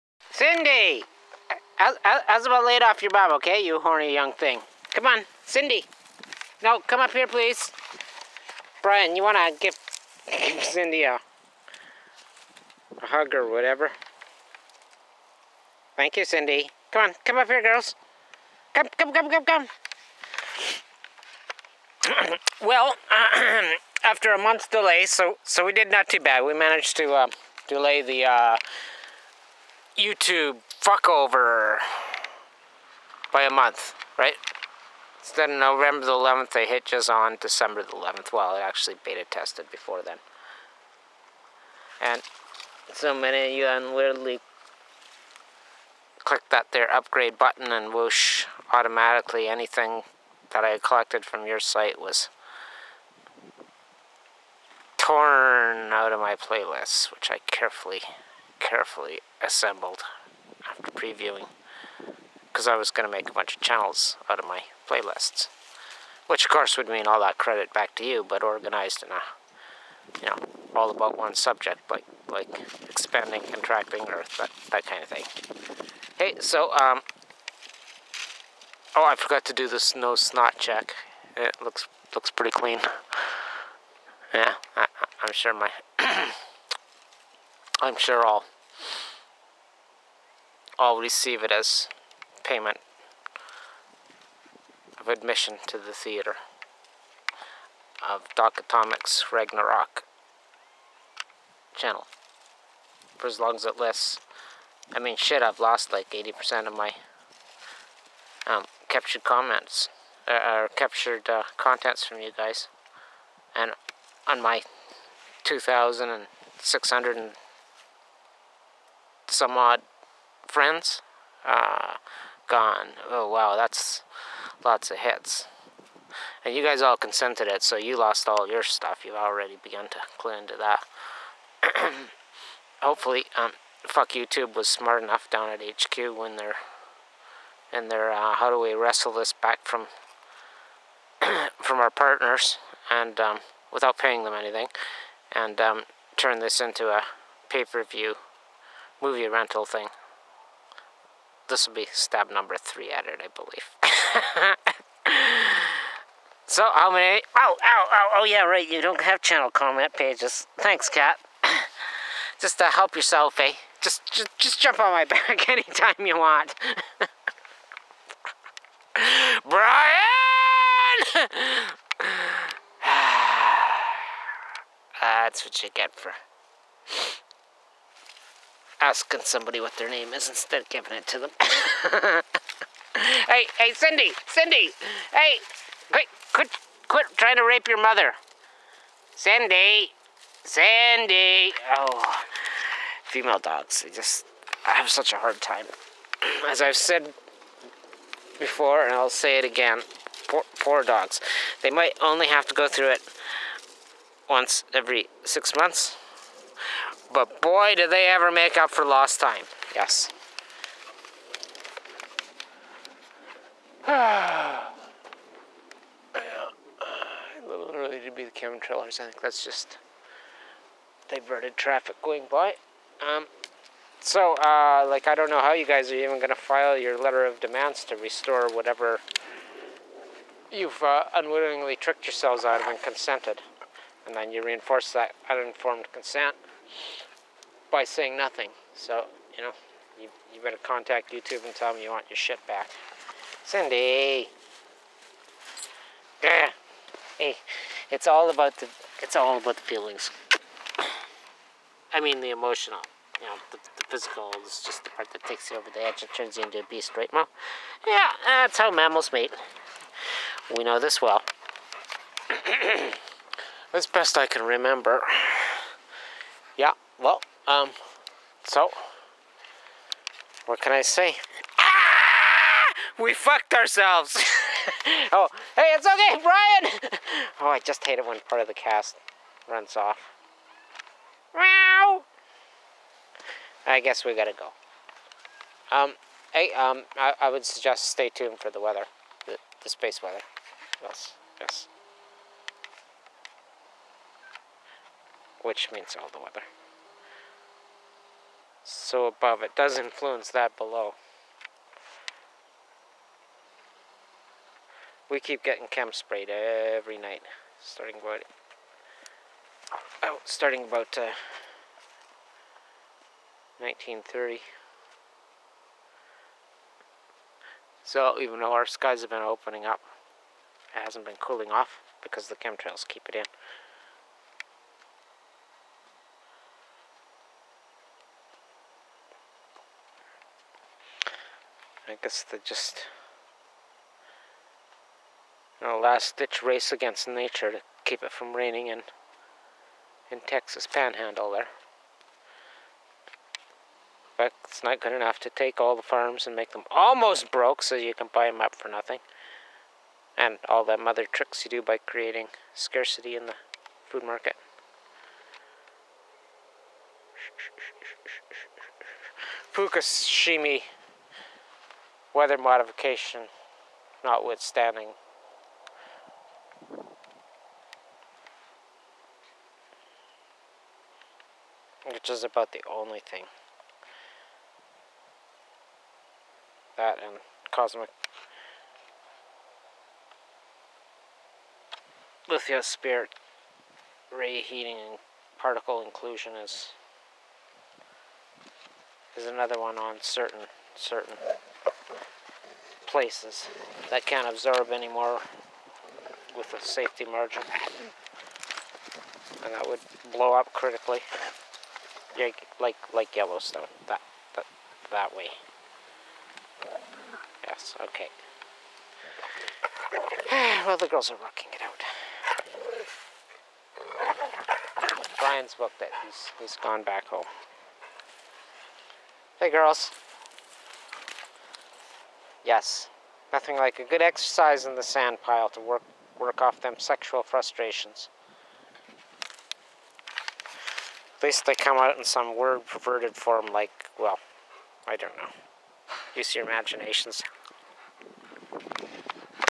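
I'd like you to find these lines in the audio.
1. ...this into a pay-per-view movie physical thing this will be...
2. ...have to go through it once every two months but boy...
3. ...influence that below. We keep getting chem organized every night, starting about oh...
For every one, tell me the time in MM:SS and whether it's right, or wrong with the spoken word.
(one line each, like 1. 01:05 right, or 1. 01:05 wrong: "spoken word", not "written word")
1. 02:26 wrong: "rental", not "physical"
2. 03:22 wrong: "six", not "two"
3. 04:59 wrong: "sprayed", not "organized".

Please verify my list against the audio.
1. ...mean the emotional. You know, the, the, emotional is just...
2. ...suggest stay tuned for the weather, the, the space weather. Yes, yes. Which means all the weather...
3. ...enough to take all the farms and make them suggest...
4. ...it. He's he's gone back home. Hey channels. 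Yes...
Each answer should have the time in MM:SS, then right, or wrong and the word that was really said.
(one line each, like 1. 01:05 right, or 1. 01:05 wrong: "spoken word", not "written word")
1. 04:11 wrong: "physical", not "emotional"
2. 04:47 right
3. 05:44 wrong: "almost", not "suggest"
4. 06:55 wrong: "girls", not "channels".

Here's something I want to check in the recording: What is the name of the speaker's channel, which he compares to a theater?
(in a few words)
Doc Atomic's Ragnarok.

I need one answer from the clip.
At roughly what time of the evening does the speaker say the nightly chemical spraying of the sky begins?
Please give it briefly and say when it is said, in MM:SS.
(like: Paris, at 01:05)
1930, at 05:13.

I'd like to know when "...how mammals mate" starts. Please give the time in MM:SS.
04:18.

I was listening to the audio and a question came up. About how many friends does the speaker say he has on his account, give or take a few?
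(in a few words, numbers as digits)
2,600.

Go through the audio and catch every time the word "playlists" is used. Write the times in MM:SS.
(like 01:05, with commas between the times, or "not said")
00:56, 01:04.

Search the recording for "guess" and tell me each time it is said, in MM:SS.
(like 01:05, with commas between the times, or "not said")
04:43, 05:32.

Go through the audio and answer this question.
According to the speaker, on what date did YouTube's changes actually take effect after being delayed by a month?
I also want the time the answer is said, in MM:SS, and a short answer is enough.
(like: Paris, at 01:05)
December 11th, at 00:37.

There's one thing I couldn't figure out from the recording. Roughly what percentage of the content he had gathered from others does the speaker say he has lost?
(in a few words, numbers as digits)
80%.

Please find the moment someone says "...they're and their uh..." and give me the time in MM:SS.
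02:16.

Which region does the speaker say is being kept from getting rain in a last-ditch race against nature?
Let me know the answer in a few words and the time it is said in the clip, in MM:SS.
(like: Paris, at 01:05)
Texas panhandle, at 05:40.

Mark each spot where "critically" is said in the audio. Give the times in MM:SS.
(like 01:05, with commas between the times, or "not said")
06:40.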